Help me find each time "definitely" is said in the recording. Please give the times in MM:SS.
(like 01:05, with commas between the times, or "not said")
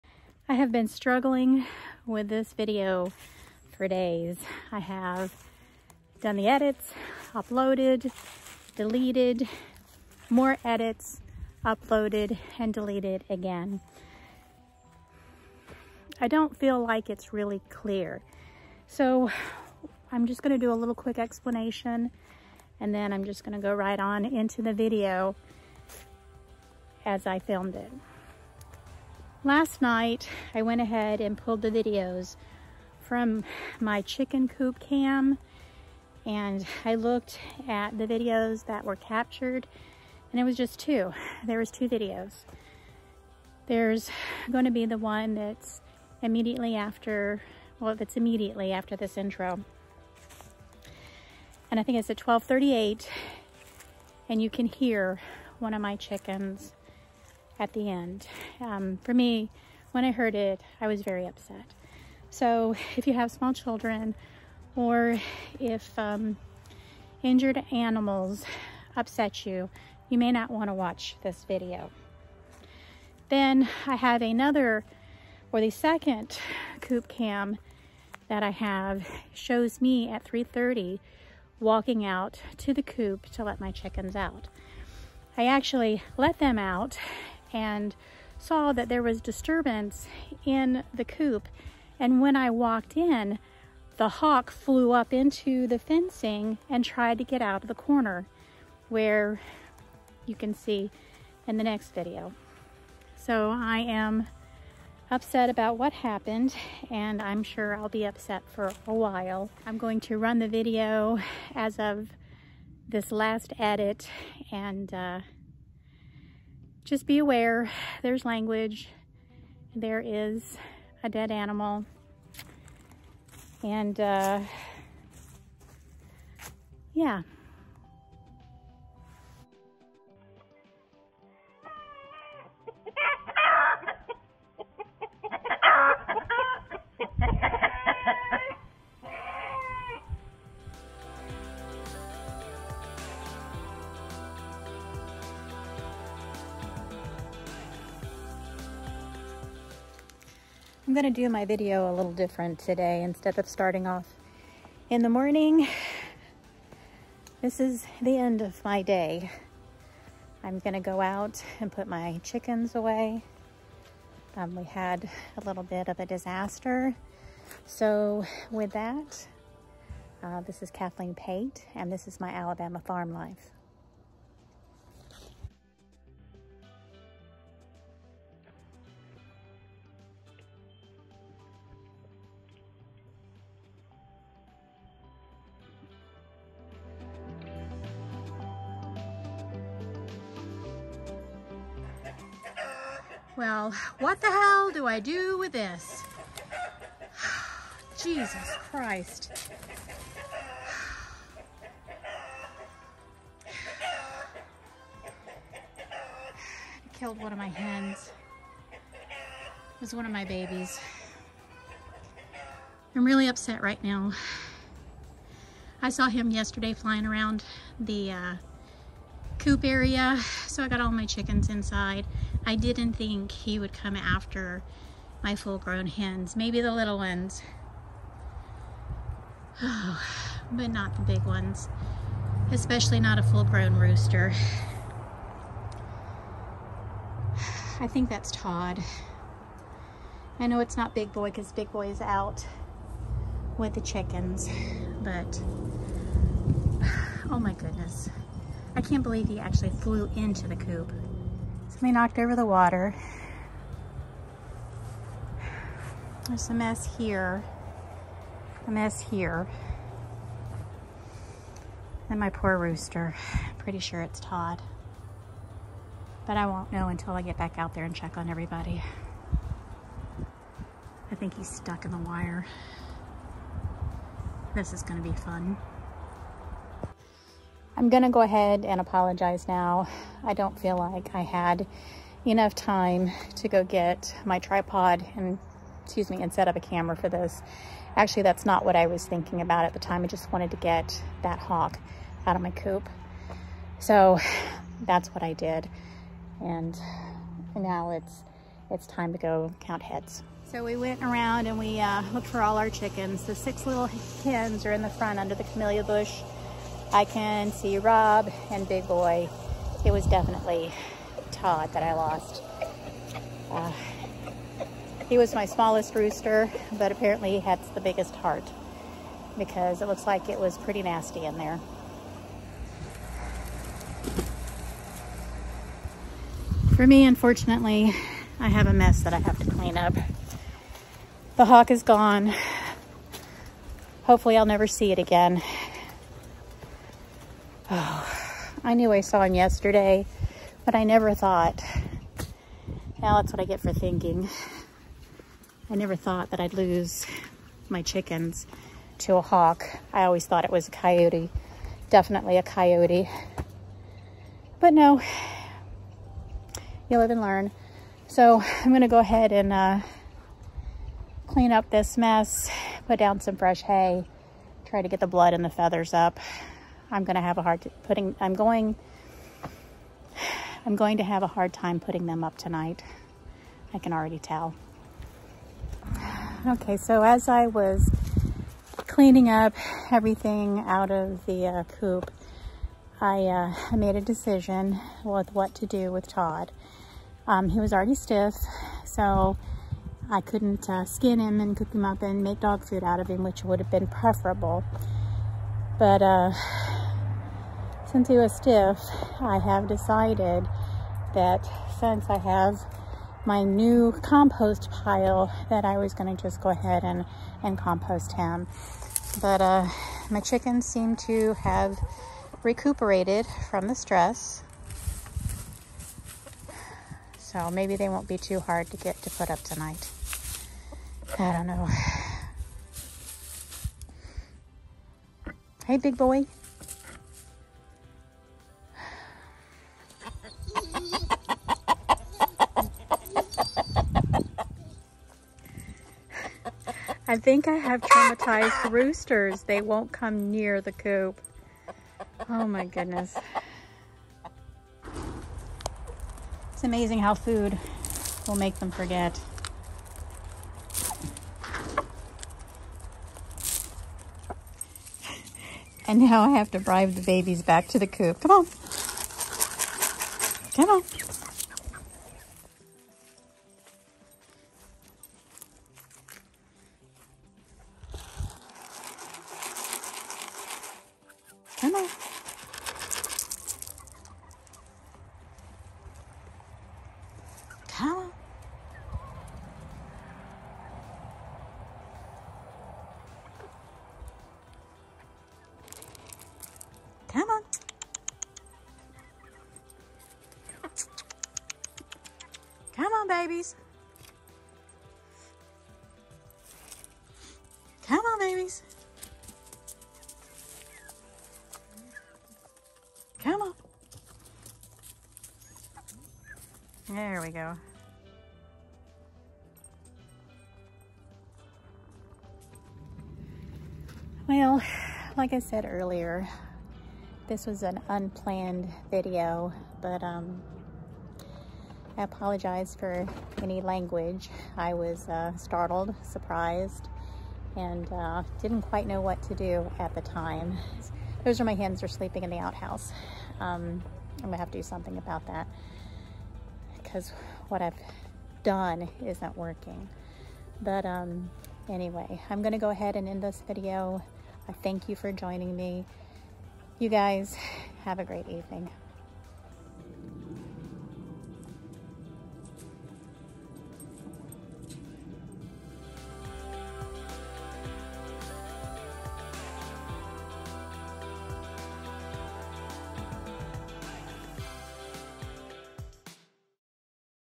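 05:10, 05:51.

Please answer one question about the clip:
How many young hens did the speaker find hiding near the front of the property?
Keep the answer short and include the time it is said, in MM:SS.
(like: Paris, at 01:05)
6, at 05:03.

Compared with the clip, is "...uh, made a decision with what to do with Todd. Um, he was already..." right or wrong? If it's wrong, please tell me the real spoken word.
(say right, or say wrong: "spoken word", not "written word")
right.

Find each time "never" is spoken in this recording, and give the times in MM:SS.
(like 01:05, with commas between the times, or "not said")
05:34, 05:40, 05:45.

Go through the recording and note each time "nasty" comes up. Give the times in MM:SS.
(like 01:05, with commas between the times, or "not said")
05:20.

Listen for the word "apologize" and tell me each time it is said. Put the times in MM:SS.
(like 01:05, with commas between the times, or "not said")
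04:38, 08:42.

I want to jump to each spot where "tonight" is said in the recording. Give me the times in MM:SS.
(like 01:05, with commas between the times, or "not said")
06:12, 06:59.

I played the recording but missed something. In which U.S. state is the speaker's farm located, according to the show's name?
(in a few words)
Alabama.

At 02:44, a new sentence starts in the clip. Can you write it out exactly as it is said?
Um, we had a little bit of a disaster.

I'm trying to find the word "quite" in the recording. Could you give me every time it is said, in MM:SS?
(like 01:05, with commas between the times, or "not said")
08:48.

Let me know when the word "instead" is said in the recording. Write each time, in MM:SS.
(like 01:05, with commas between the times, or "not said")
02:33.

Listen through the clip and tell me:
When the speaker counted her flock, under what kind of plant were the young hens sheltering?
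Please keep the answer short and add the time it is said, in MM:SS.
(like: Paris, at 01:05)
camellia bush, at 05:05.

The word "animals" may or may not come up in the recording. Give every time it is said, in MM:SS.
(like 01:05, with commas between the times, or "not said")
01:07, 02:01.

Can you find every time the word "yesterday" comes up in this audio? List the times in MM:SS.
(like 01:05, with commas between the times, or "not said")
03:36, 05:39.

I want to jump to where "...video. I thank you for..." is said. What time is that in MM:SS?
09:03.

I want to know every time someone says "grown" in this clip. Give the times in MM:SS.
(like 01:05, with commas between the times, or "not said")
03:45, 03:53.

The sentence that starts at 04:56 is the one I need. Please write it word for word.
And now it's, it's time to go count heads.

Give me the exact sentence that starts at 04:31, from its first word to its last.
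I think he's stuck in the wire.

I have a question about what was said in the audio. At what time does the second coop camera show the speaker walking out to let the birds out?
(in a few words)
3:30.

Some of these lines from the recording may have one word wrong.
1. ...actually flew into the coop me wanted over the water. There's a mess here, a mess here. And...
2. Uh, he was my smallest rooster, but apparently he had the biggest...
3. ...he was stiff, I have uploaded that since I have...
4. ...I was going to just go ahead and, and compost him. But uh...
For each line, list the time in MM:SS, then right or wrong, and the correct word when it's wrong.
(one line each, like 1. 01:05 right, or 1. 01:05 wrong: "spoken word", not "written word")
1. 04:09 wrong: "knocked", not "wanted"
2. 05:13 right
3. 06:38 wrong: "decided", not "uploaded"
4. 06:45 right.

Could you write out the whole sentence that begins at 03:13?
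Well, what the hell do I do with this?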